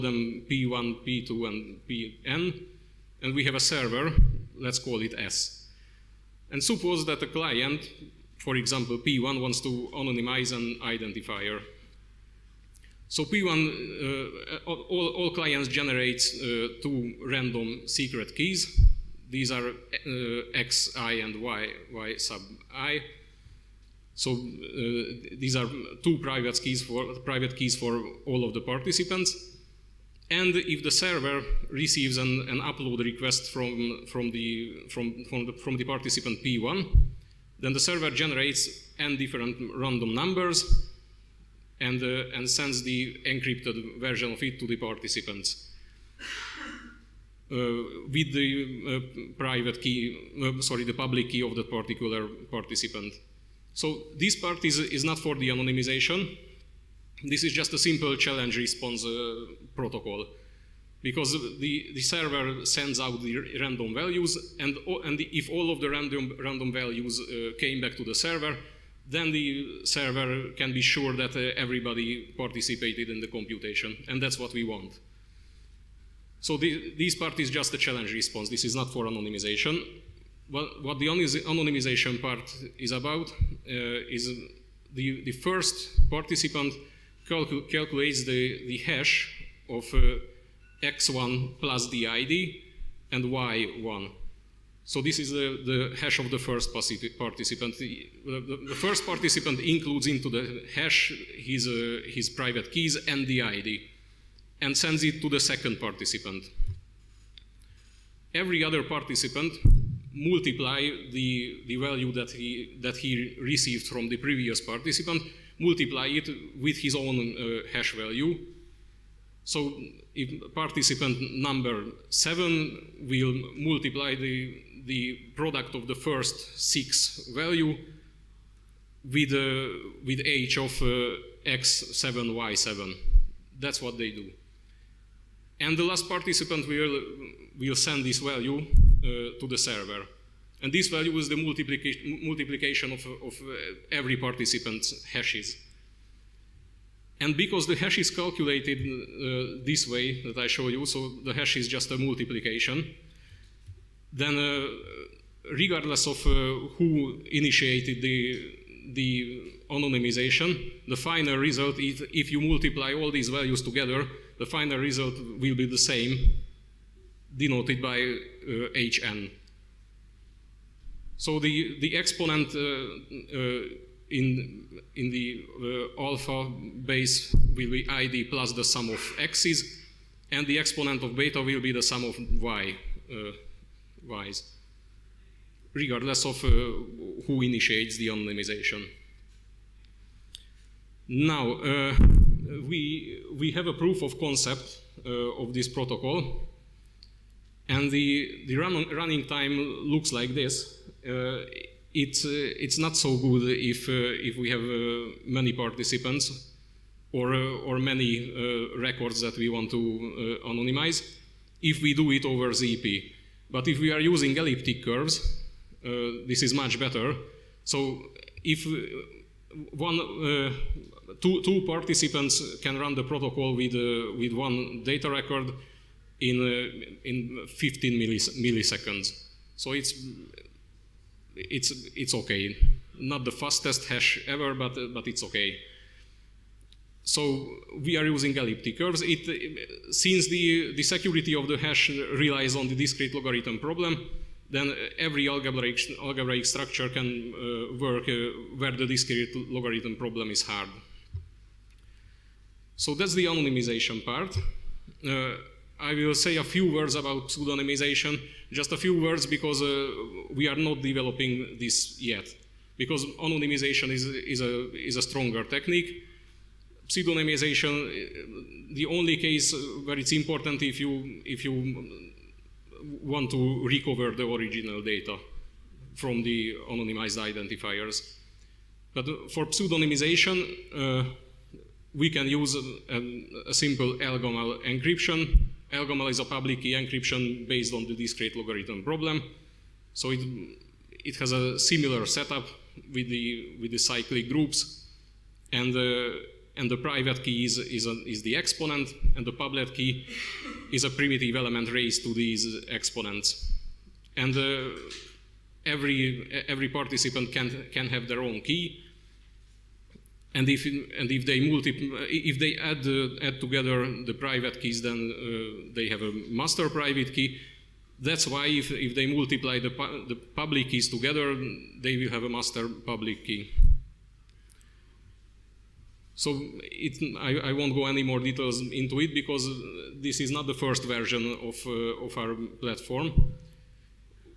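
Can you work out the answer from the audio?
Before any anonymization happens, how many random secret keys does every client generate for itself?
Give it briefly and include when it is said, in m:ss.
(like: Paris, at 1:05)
2, at 0:16.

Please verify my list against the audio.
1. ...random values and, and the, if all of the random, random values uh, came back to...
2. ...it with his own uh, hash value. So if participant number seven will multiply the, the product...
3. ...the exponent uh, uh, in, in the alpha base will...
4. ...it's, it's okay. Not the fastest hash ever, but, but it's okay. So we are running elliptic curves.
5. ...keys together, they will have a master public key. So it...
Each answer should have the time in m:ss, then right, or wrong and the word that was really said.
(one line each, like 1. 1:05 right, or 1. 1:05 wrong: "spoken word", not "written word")
1. 1:03 right
2. 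1:56 right
3. 2:51 right
4. 3:51 wrong: "using", not "running"
5. 5:20 right.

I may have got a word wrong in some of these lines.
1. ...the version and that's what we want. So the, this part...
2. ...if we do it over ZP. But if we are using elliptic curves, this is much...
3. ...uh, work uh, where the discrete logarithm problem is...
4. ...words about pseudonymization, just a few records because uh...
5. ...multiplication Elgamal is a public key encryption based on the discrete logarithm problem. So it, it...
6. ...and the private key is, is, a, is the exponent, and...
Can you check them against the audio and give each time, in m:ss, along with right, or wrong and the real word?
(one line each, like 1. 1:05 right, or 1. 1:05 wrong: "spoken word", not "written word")
1. 1:13 wrong: "computation", not "version"
2. 3:31 right
3. 4:07 right
4. 4:16 wrong: "words", not "records"
5. 4:44 wrong: "encryption", not "multiplication"
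6. 4:56 right.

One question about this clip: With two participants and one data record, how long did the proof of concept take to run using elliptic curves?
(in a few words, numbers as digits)
15 milliseconds.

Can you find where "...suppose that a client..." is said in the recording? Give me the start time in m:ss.
0:06.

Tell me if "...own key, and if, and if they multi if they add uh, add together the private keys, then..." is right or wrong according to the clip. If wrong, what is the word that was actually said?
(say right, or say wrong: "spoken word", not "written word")
right.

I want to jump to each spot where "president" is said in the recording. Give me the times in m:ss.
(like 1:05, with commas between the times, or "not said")
not said.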